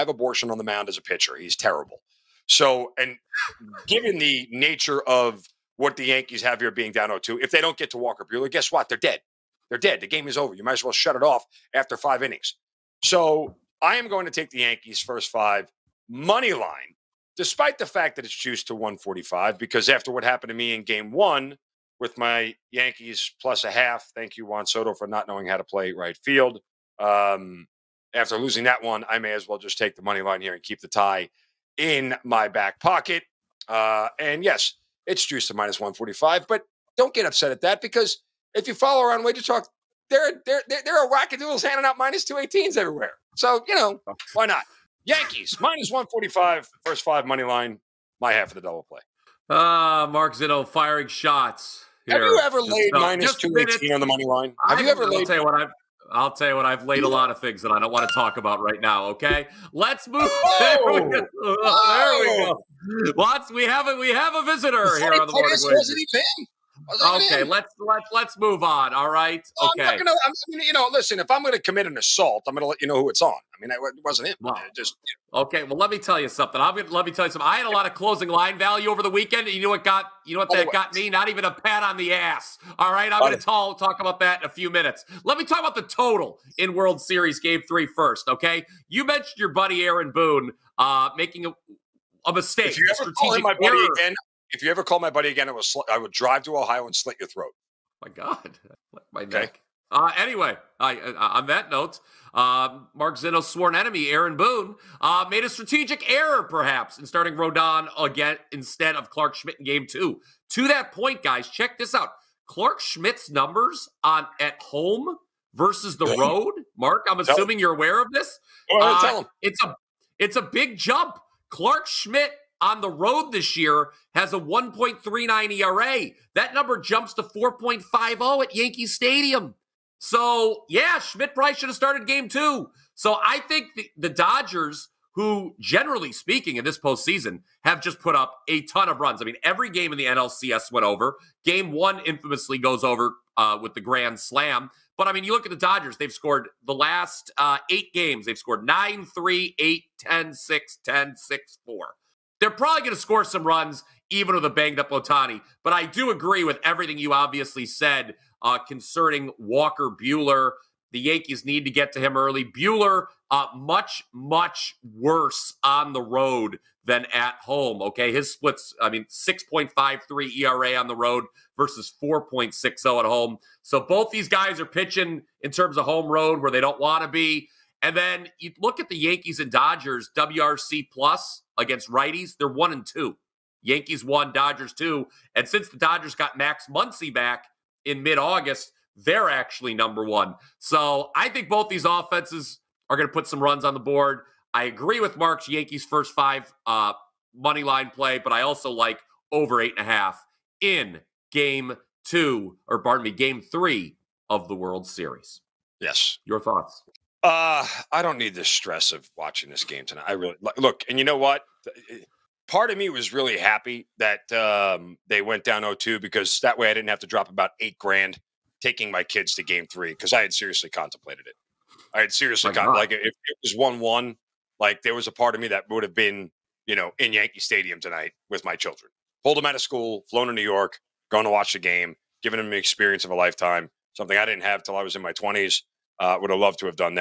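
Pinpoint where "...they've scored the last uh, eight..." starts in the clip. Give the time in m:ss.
2:25.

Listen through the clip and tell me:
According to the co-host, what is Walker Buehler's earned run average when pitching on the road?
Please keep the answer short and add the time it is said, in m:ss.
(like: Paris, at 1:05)
6.53, at 2:49.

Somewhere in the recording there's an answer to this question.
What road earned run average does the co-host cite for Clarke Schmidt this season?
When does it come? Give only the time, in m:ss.
2:04.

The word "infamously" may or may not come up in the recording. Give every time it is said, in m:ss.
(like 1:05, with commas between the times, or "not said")
2:22.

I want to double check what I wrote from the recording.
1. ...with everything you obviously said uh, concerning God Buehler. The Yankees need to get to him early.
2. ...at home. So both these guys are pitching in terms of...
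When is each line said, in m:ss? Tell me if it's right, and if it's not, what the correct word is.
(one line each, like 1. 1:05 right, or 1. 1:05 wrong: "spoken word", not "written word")
1. 2:36 wrong: "Walker", not "God"
2. 2:52 right.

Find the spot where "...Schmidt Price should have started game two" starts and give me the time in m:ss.
2:10.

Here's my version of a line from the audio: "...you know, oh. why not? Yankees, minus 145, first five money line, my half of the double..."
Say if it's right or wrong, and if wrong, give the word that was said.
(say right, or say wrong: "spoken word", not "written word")
right.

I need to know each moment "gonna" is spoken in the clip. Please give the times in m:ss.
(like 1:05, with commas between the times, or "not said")
1:09, 1:16.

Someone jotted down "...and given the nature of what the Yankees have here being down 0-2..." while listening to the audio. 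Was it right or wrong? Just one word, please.
right.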